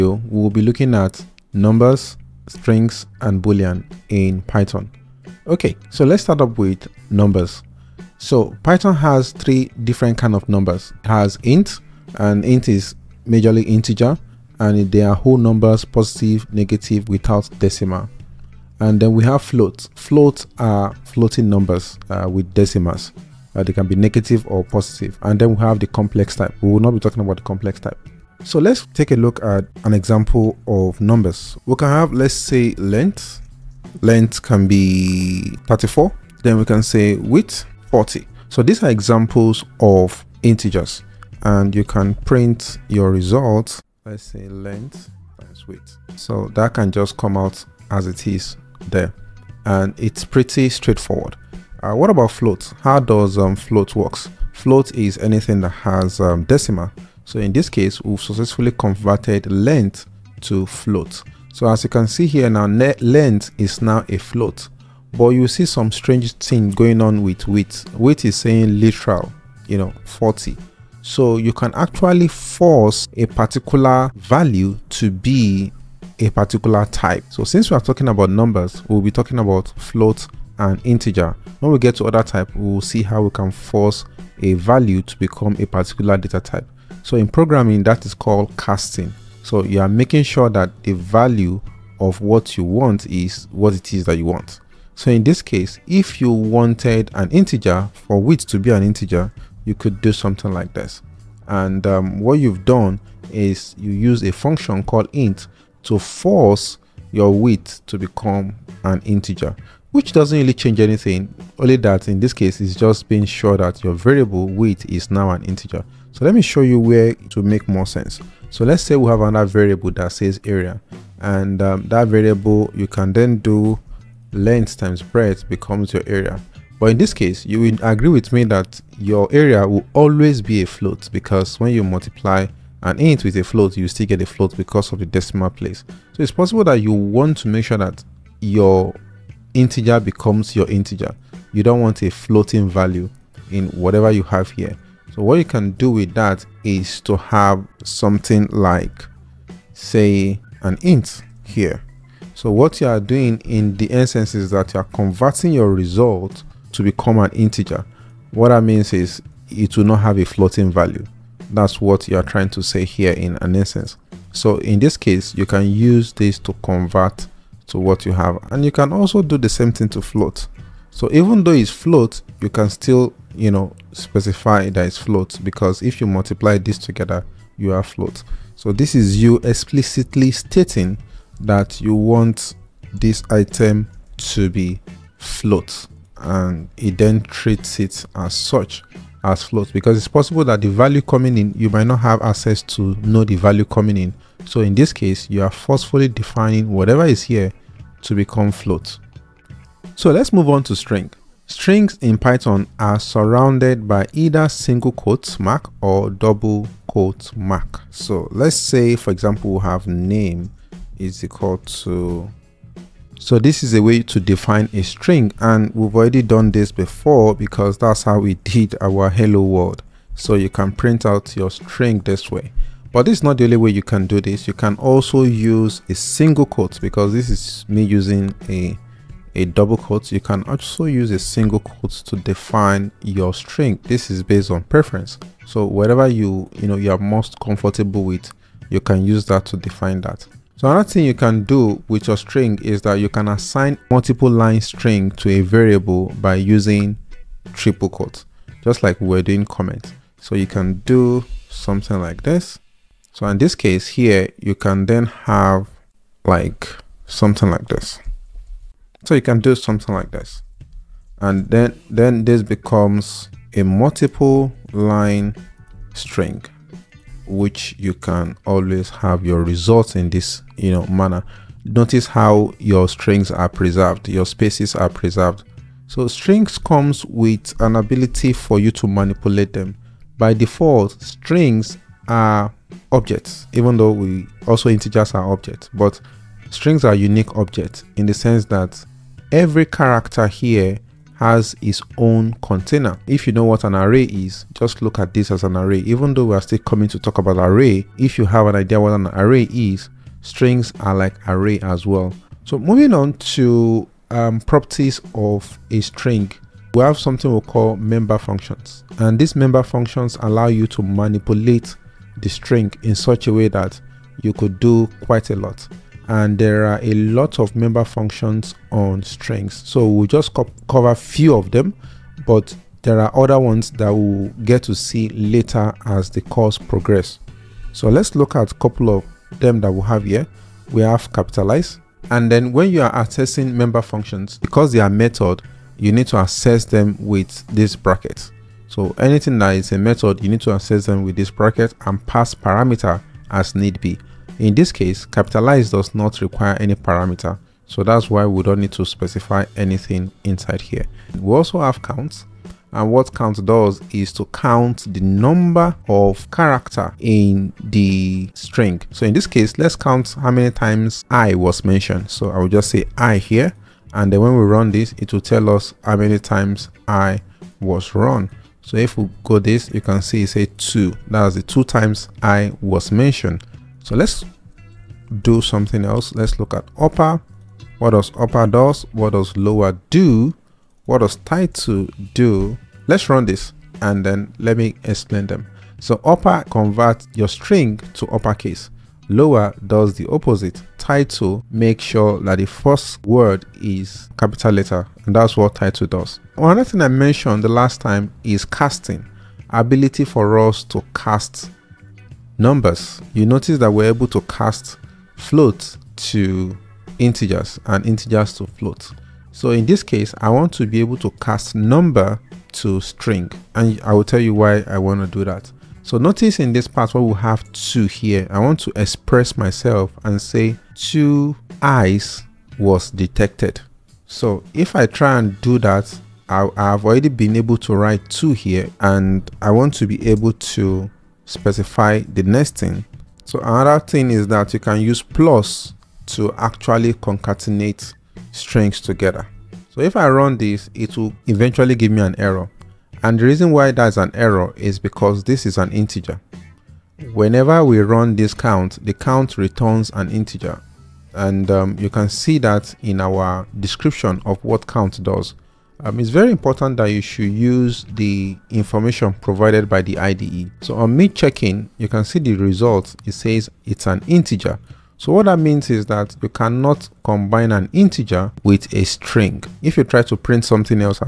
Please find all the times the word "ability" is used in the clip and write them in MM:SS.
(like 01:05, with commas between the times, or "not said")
04:37, 06:39.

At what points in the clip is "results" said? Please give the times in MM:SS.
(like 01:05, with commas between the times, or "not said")
00:43, 02:35, 04:29, 07:42.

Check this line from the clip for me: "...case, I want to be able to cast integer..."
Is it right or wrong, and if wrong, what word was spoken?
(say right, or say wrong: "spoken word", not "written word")
wrong: "number", not "integer".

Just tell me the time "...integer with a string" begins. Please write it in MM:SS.
07:47.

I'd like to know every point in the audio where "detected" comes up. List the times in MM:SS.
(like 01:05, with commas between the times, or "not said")
07:02.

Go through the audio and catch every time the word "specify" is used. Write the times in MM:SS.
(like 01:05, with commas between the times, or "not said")
02:53, 05:48, 07:11.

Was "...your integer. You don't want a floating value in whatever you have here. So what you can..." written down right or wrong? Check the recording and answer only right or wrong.
right.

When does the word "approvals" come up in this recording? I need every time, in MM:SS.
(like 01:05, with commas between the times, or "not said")
not said.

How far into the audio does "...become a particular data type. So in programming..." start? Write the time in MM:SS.
01:25.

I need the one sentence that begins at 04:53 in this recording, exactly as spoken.
If you know what an array is, just look at this as an array.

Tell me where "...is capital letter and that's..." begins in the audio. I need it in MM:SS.
06:33.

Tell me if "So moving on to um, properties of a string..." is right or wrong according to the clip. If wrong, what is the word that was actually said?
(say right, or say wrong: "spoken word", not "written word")
right.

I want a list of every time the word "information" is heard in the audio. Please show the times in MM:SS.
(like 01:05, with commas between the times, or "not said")
07:38.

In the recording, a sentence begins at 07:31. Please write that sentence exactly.
And um, you can see that in our description of what count does.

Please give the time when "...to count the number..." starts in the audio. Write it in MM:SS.
05:54.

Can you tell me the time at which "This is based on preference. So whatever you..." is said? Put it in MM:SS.
03:53.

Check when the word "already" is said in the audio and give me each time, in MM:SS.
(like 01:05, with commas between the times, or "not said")
03:35, 07:06.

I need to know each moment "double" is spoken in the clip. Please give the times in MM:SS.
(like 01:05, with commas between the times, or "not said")
03:26, 03:49.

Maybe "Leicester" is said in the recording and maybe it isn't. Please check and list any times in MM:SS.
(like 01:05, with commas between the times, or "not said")
not said.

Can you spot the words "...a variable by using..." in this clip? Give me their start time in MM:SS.
04:05.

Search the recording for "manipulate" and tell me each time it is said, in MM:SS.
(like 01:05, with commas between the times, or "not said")
04:38, 05:10.